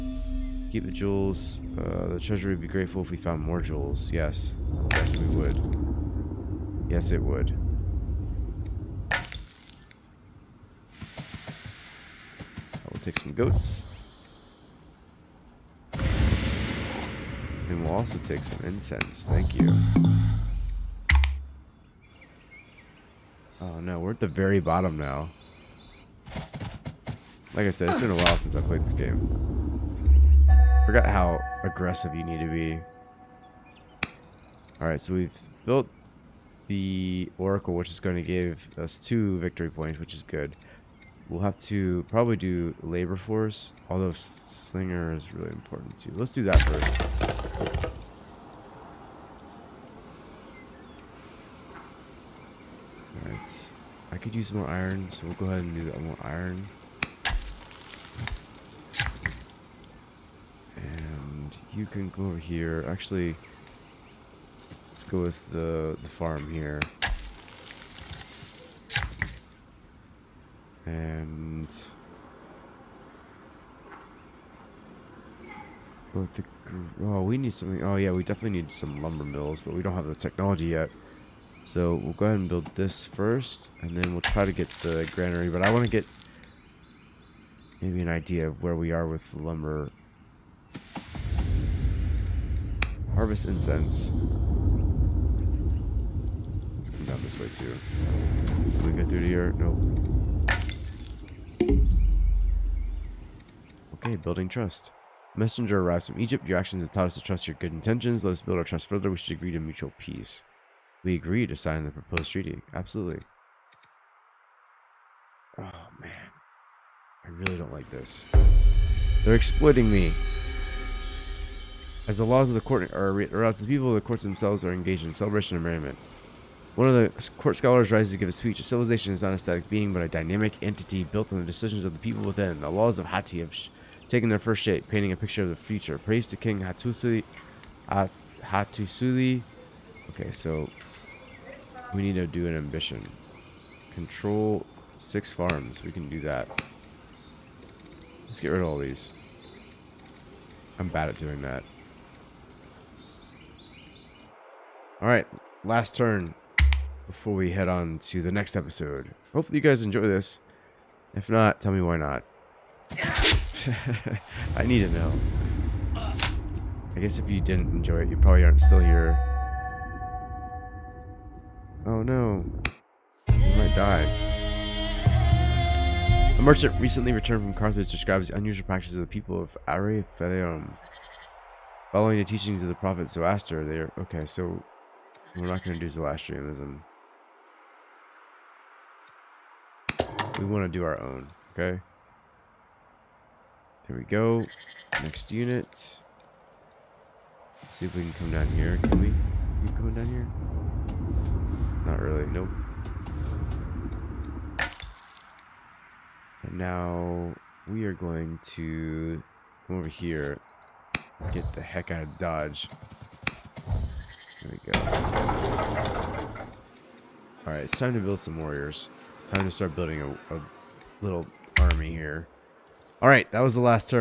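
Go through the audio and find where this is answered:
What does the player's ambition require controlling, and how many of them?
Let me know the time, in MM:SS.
02:24.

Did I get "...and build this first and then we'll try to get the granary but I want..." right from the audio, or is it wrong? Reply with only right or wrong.
right.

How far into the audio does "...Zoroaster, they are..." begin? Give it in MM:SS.
03:03.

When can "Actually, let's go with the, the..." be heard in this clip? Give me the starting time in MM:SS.
01:02.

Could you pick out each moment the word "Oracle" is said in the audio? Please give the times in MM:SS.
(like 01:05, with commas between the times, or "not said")
00:37.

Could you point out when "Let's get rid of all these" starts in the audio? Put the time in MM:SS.
02:28.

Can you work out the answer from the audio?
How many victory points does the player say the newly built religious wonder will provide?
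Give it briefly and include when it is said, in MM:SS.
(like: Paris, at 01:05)
2, at 00:39.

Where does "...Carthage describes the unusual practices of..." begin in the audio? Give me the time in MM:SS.
02:57.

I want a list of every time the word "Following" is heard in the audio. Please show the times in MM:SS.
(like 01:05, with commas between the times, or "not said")
03:01.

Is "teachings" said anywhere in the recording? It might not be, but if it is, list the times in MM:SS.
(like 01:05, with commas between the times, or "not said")
03:02.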